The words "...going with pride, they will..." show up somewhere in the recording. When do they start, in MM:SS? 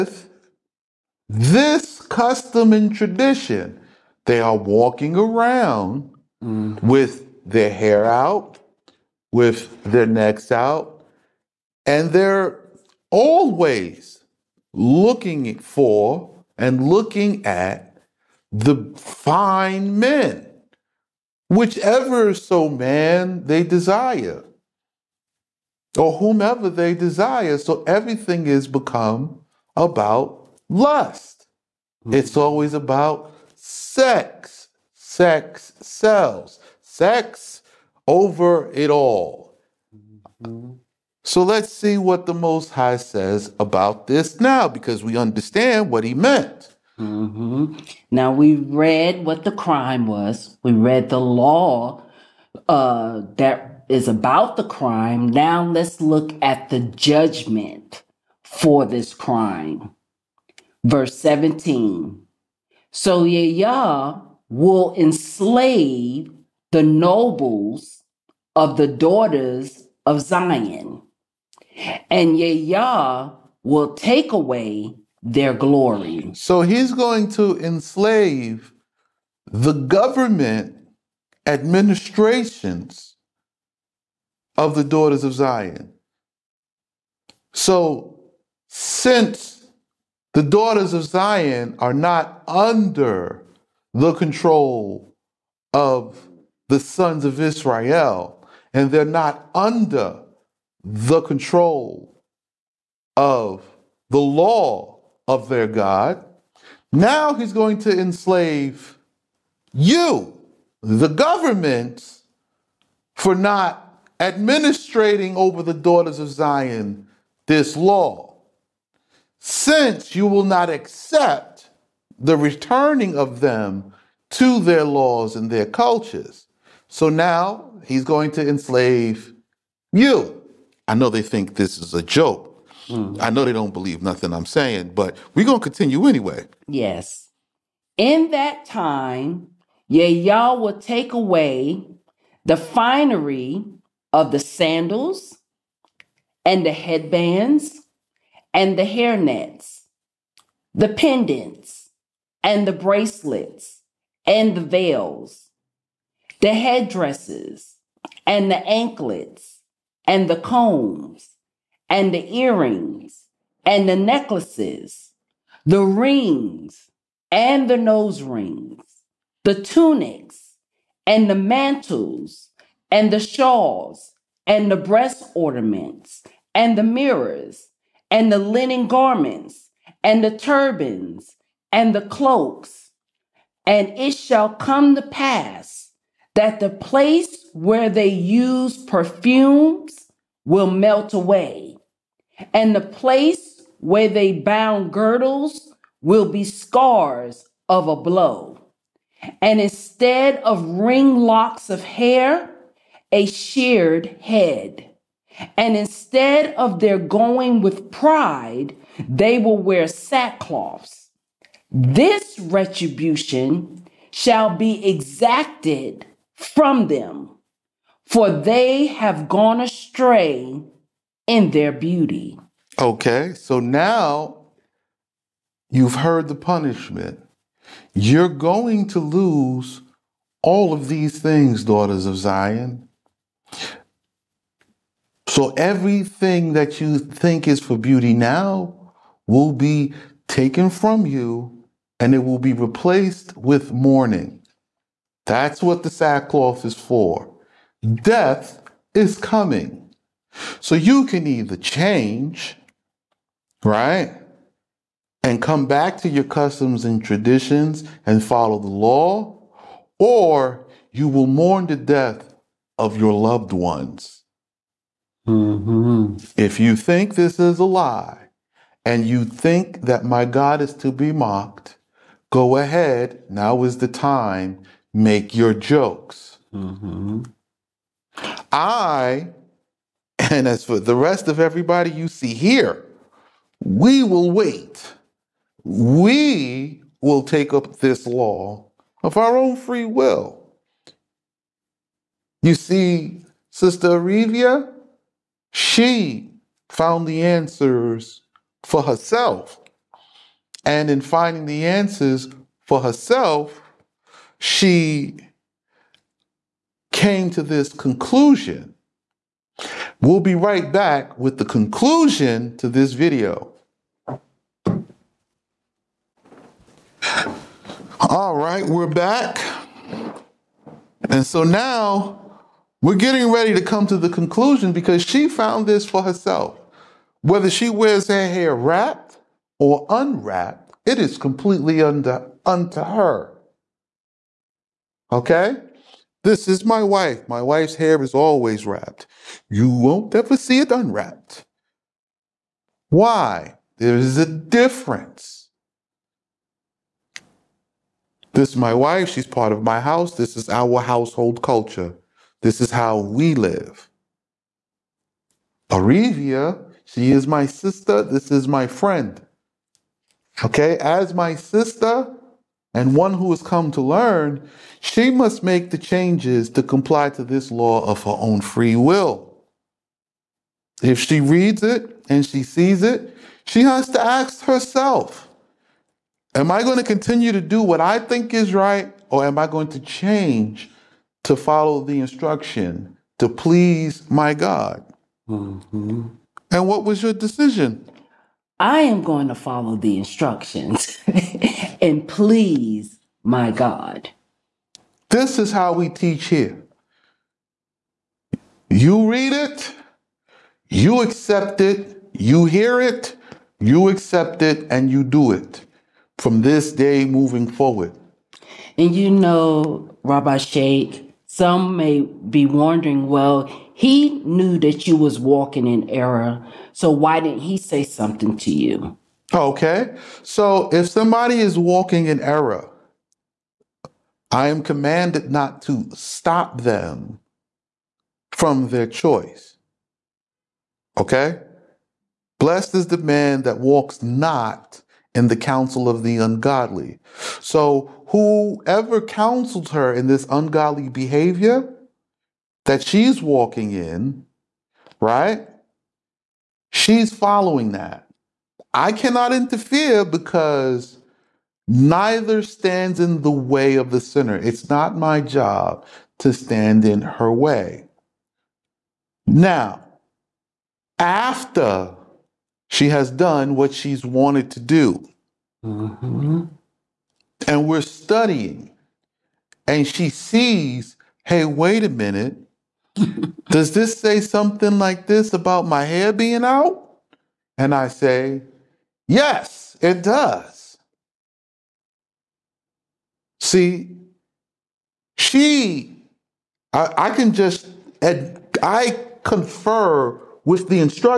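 03:26.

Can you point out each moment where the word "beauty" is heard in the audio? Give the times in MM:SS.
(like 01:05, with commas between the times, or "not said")
03:41, 03:57.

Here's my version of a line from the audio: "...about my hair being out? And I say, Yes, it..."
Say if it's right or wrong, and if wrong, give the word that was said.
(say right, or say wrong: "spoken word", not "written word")
right.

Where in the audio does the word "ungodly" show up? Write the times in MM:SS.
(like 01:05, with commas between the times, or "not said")
07:16, 07:20.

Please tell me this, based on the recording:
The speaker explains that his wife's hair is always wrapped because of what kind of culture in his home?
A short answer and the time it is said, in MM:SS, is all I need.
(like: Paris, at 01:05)
Household culture, at 05:50.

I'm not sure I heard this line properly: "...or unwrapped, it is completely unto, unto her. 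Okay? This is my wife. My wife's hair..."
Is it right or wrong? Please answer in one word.
right.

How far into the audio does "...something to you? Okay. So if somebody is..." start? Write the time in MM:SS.
06:57.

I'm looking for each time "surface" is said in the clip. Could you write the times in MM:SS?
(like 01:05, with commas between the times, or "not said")
not said.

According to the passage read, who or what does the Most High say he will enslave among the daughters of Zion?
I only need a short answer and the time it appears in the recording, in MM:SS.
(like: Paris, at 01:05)
The nobles, at 01:06.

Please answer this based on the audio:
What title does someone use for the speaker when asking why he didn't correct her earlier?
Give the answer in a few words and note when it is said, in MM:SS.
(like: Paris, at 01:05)
Rabbi Sheikh, at 06:50.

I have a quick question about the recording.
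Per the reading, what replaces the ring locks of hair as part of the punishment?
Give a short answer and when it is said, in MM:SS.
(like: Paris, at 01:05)
A sheared head, at 03:23.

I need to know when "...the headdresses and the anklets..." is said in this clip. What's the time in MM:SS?
02:36.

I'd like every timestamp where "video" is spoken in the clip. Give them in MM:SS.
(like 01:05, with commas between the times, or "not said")
05:12.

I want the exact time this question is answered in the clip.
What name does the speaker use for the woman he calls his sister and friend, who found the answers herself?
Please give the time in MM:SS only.
04:53.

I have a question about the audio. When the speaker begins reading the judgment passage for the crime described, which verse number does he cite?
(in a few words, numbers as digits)
17.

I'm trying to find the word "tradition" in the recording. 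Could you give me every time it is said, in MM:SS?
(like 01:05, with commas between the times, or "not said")
00:02, 04:17.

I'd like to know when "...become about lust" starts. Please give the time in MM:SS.
00:28.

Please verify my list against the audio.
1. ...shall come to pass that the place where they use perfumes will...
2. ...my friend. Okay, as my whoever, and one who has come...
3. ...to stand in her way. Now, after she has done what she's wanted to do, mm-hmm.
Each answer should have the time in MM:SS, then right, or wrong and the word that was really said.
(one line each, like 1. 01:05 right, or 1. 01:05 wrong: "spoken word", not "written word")
1. 03:04 right
2. 05:58 wrong: "sister", not "whoever"
3. 07:36 right.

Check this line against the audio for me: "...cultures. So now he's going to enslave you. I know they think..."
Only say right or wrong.
right.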